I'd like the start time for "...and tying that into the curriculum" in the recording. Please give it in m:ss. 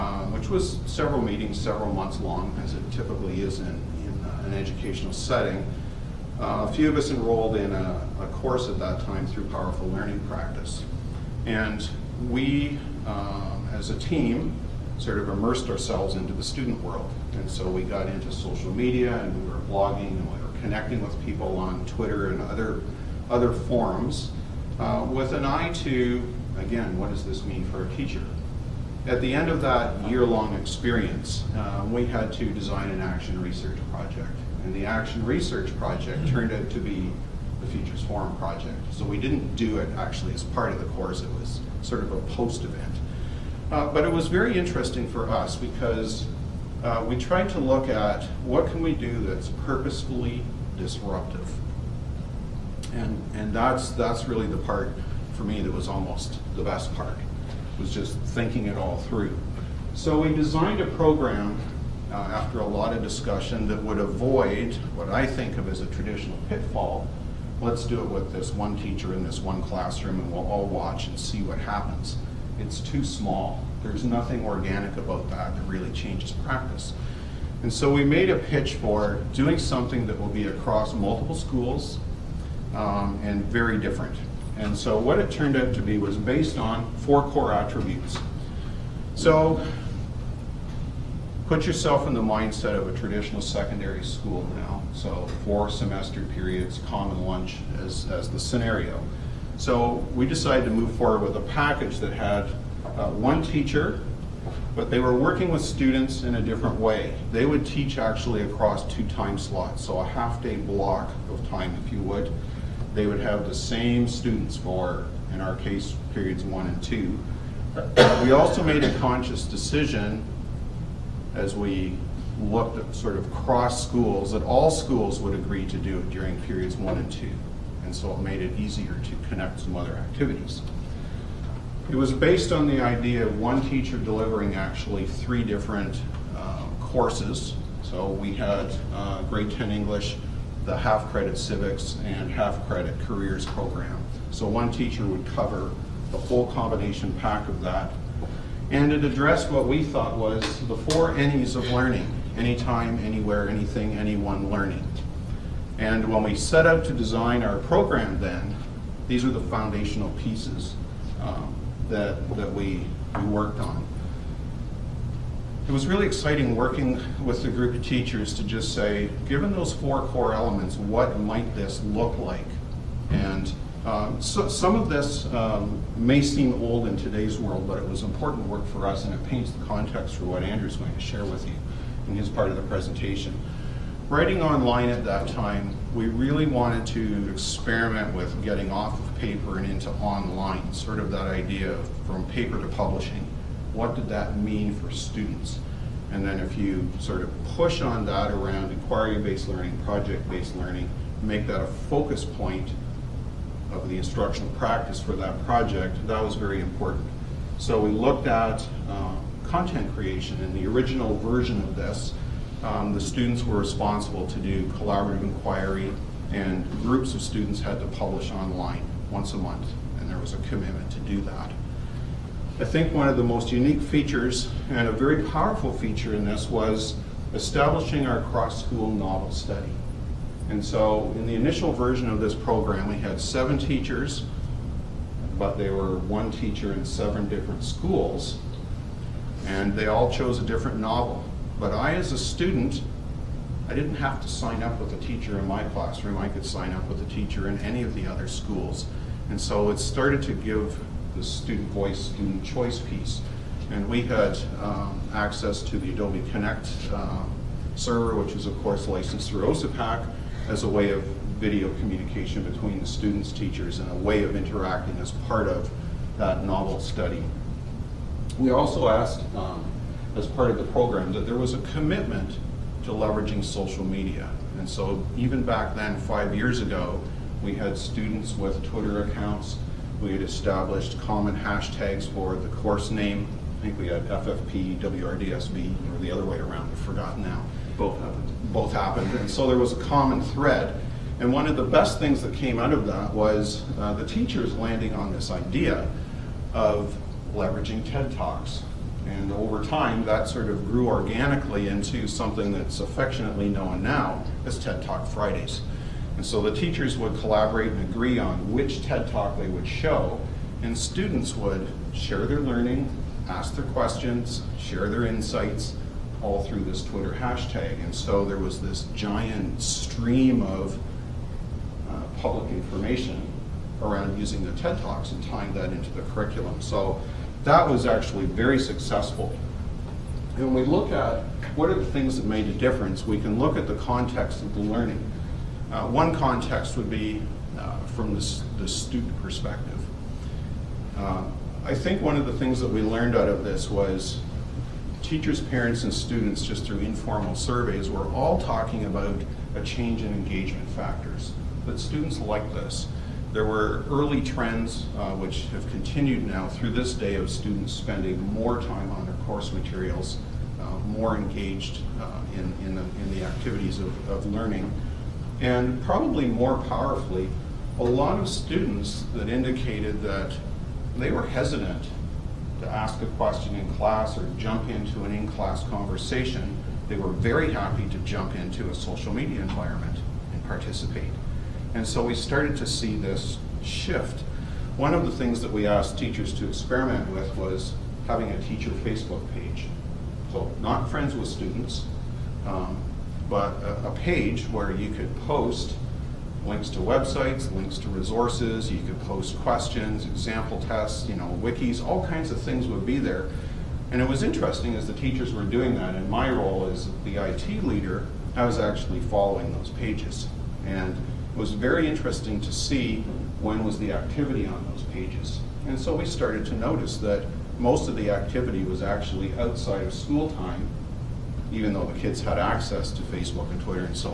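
5:25.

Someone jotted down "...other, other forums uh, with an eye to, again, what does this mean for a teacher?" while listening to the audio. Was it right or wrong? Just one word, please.
right.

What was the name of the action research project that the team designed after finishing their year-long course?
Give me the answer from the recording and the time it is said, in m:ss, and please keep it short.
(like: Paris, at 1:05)
Futures Forum Project, at 0:37.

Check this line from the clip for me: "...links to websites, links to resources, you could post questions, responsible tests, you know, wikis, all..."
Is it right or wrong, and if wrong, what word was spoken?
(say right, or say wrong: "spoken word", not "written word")
wrong: "example", not "responsible".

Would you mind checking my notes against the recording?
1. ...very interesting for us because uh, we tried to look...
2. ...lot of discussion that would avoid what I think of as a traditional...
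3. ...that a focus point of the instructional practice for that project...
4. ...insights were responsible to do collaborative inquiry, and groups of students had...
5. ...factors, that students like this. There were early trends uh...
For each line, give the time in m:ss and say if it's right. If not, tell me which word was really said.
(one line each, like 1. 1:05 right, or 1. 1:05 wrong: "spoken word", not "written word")
1. 0:44 right
2. 1:02 right
3. 3:21 right
4. 3:32 wrong: "students", not "insights"
5. 5:50 right.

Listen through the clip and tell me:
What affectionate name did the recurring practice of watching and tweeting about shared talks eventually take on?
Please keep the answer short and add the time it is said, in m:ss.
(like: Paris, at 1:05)
TED Talk Fridays, at 5:04.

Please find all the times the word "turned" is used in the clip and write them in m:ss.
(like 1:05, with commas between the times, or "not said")
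0:36, 1:25.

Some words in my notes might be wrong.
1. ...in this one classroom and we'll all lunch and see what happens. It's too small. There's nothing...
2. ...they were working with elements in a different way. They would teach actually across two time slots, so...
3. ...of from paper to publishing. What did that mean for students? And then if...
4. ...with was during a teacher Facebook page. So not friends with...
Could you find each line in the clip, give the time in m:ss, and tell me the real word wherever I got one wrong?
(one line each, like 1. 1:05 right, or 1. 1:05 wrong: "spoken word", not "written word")
1. 1:09 wrong: "watch", not "lunch"
2. 1:44 wrong: "students", not "elements"
3. 3:11 right
4. 6:27 wrong: "having", not "during".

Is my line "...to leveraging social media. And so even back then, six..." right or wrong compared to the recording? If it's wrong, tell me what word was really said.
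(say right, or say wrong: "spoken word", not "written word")
wrong: "five", not "six".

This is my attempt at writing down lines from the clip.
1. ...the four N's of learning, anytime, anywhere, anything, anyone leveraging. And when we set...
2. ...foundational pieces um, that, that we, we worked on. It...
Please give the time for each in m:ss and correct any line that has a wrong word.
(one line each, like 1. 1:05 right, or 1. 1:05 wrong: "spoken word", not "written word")
1. 2:30 wrong: "learning", not "leveraging"
2. 2:39 right.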